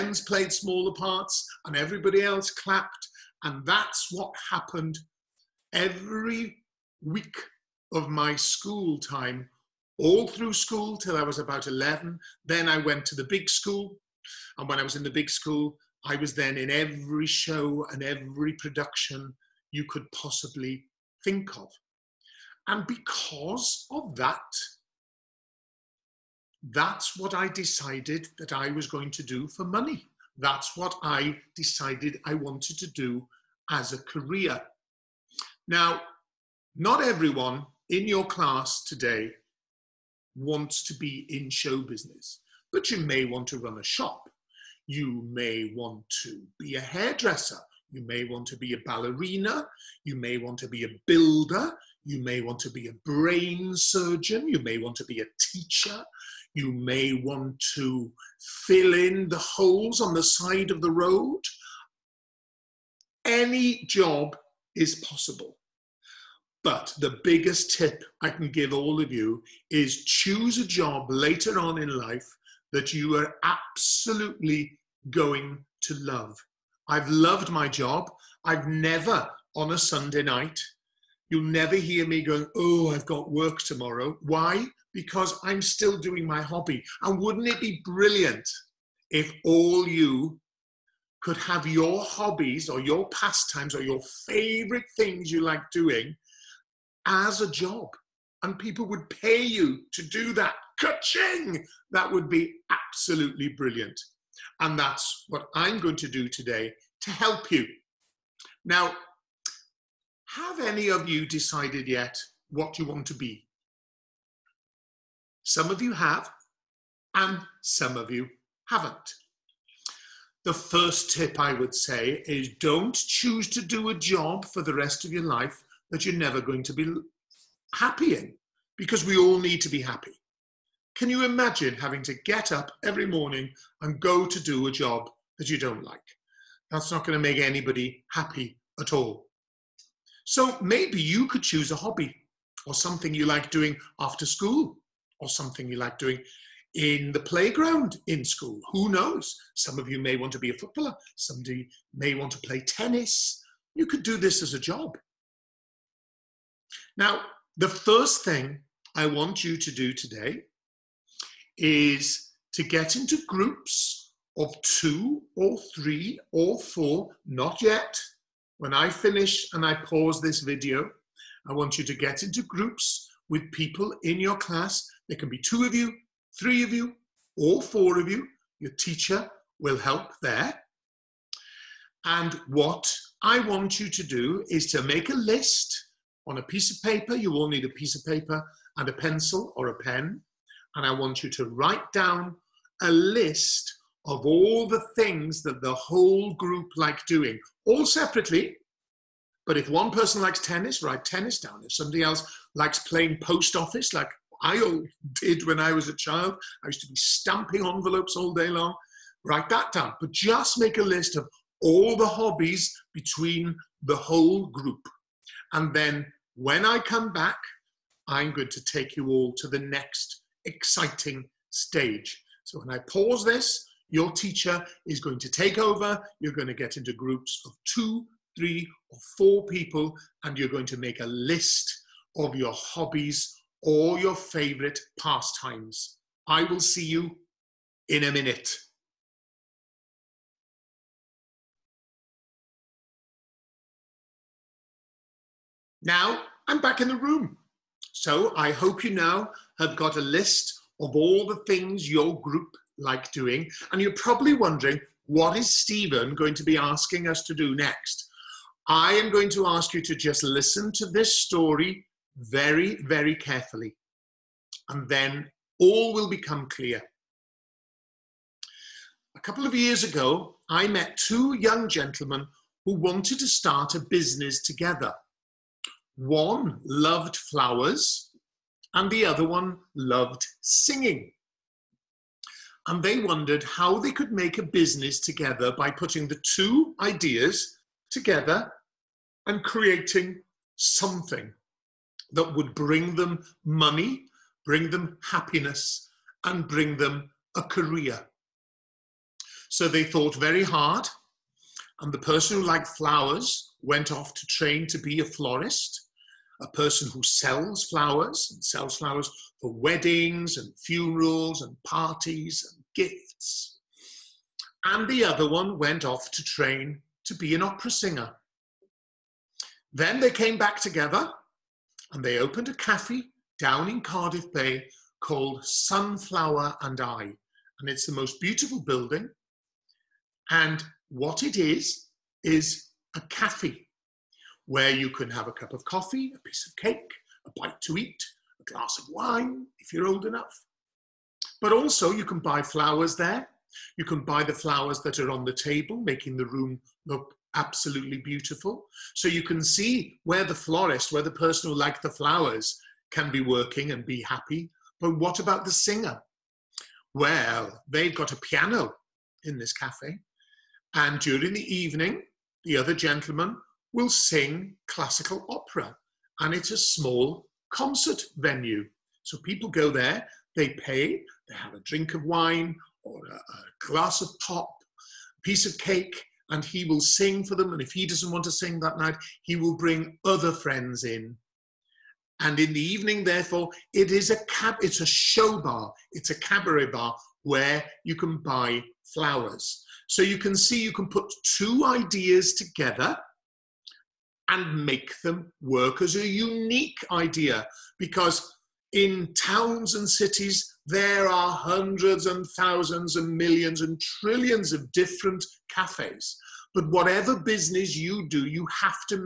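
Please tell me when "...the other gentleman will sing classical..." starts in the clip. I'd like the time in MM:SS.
06:02.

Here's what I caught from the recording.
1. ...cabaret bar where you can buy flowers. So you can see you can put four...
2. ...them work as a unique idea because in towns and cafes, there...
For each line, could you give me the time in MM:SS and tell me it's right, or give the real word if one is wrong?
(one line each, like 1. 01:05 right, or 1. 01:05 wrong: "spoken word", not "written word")
1. 06:26 wrong: "two", not "four"
2. 06:35 wrong: "cities", not "cafes".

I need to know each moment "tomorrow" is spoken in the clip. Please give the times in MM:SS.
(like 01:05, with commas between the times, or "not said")
01:23.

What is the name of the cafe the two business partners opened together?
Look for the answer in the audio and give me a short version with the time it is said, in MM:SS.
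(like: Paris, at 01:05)
Sunflower and I, at 05:25.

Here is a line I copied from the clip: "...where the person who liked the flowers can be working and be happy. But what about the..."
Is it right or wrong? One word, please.
right.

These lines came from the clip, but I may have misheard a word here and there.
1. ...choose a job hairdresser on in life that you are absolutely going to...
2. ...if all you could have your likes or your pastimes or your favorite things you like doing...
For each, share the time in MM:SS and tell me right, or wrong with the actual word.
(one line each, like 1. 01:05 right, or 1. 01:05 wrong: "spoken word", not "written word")
1. 01:10 wrong: "later", not "hairdresser"
2. 01:29 wrong: "hobbies", not "likes".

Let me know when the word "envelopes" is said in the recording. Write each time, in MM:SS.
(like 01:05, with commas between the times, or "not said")
03:27.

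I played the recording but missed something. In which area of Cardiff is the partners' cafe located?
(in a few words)
Cardiff Bay.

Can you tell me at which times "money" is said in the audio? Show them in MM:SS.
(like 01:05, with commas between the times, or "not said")
00:29, 04:53.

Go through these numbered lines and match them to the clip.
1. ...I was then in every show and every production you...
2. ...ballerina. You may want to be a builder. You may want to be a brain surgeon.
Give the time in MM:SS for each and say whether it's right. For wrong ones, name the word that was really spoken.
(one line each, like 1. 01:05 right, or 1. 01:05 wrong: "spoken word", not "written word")
1. 00:16 right
2. 00:48 right.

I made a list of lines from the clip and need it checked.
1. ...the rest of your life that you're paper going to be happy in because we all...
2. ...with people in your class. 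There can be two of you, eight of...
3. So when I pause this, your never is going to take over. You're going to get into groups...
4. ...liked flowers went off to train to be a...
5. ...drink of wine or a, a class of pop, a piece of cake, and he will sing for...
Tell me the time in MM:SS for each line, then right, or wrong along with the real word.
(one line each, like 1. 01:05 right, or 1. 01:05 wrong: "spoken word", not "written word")
1. 02:04 wrong: "never", not "paper"
2. 02:53 wrong: "three", not "eight"
3. 03:42 wrong: "teacher", not "never"
4. 05:02 right
5. 06:11 wrong: "glass", not "class".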